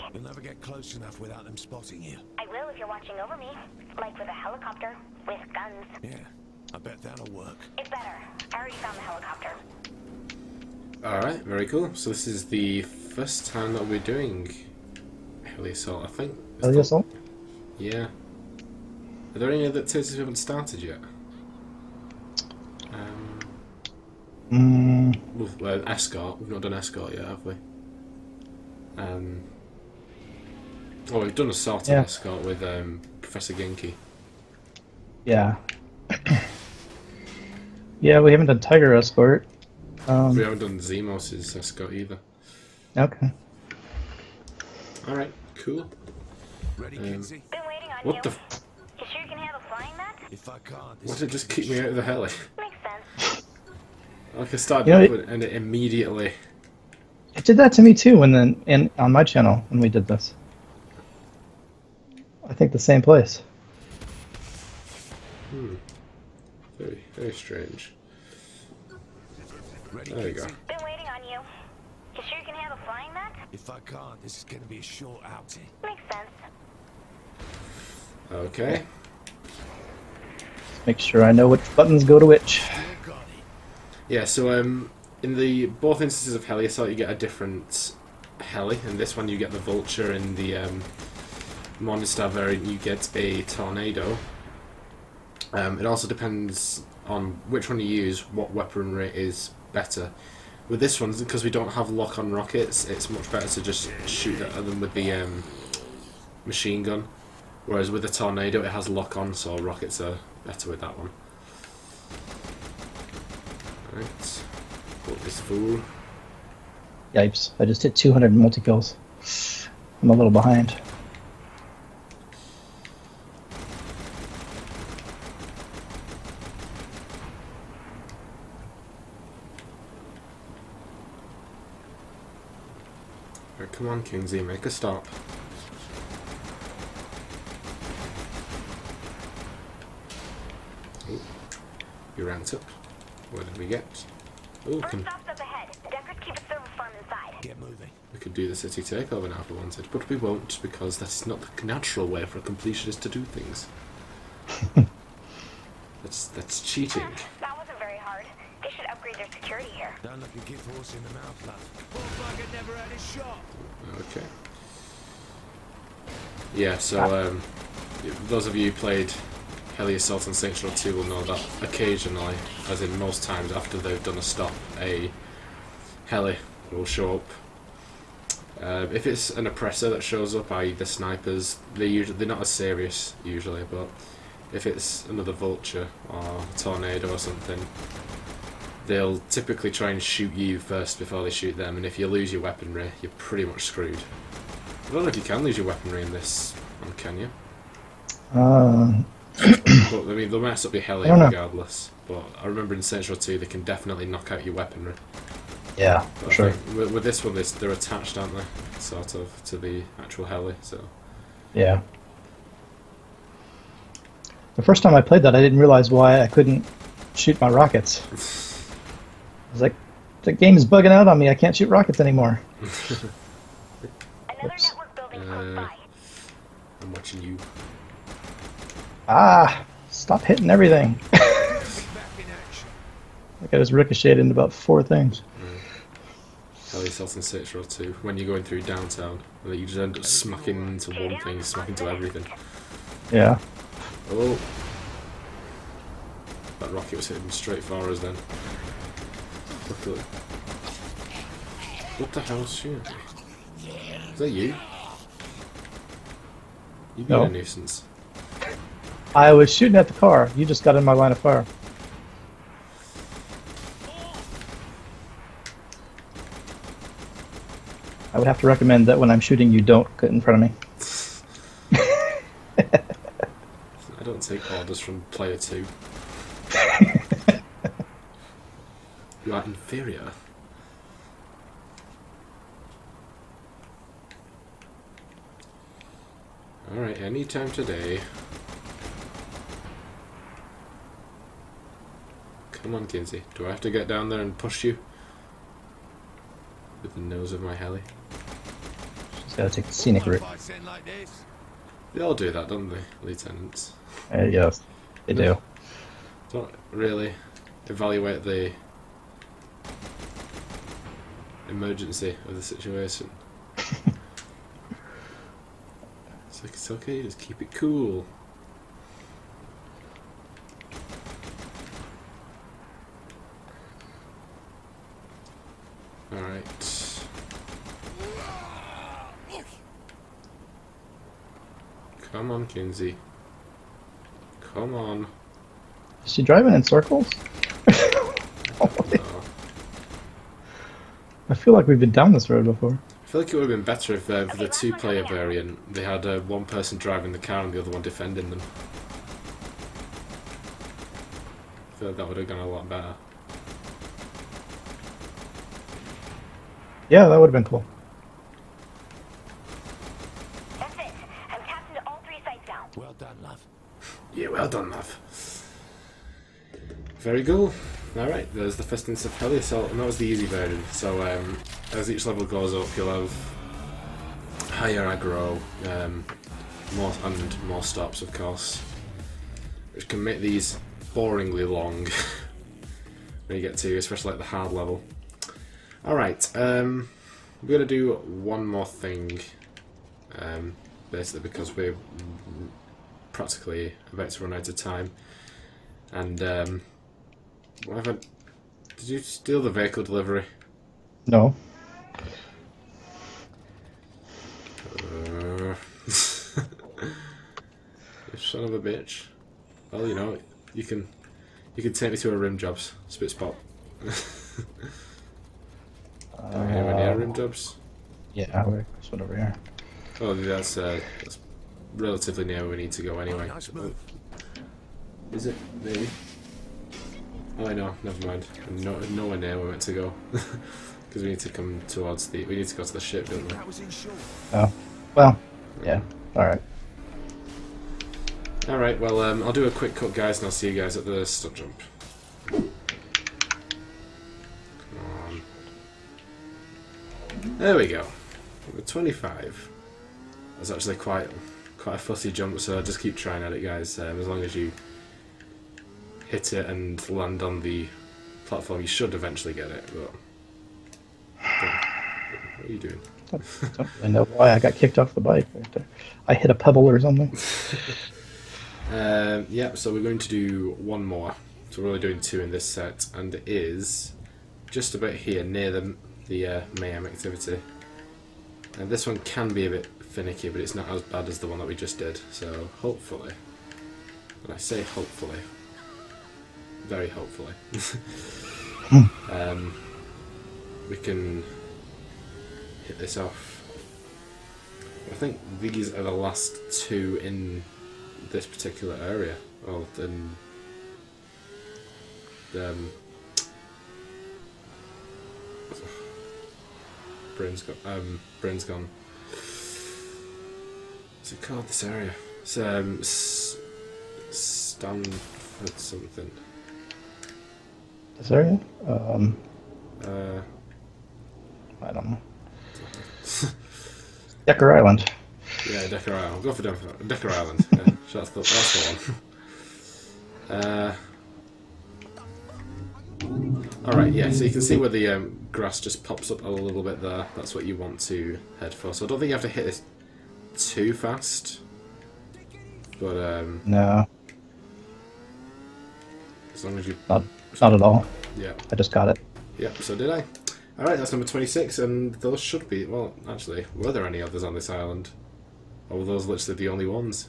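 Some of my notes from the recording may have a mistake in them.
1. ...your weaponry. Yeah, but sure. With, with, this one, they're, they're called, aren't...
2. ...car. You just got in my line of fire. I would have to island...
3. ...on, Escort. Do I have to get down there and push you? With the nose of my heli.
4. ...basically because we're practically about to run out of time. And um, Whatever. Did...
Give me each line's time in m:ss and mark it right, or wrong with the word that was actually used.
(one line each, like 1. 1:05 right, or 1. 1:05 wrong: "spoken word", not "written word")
1. 3:24 wrong: "attached", not "called"
2. 4:19 wrong: "recommend", not "island"
3. 4:52 wrong: "Kinzie", not "Escort"
4. 6:30 right.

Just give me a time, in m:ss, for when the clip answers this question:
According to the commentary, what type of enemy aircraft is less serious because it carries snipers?
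2:59.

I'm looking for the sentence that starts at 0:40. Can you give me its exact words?
Um, we haven't done Zimos escort either.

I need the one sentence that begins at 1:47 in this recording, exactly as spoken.
Whereas with the tornado, it has lock-on, so rockets are better with that one.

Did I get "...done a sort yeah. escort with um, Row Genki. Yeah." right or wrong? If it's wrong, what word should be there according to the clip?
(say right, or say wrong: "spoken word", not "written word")
wrong: "Professor", not "Row".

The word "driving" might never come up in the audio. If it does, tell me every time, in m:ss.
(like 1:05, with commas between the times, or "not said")
5:36, 5:46.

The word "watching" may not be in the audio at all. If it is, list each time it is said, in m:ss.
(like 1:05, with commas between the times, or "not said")
0:02, 3:46.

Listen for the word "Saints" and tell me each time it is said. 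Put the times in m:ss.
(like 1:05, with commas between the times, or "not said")
2:50, 3:22.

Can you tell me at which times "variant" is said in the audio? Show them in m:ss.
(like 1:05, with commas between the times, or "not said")
1:32, 5:45.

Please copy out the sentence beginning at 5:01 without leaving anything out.
They all do that, don't they, lieutenants?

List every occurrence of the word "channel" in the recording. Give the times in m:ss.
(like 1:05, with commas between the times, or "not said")
0:59.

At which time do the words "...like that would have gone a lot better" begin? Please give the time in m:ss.
5:51.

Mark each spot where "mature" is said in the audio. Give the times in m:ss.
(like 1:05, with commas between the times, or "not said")
not said.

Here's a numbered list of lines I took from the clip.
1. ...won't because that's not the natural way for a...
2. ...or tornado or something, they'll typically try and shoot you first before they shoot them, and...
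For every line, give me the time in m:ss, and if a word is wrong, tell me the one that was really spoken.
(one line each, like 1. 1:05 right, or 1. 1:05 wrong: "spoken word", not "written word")
1. 2:30 right
2. 3:06 right.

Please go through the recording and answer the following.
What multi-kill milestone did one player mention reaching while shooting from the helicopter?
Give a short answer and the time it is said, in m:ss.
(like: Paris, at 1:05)
200, at 1:57.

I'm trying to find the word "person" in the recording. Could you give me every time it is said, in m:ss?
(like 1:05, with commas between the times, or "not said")
5:46.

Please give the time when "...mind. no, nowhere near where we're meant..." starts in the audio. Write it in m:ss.
7:08.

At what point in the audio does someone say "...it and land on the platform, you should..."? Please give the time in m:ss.
7:36.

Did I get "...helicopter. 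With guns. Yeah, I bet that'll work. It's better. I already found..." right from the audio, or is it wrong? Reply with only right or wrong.
right.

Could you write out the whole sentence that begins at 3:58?
When you're going through downtown, you just end up smacking into one thing, smacking into everything.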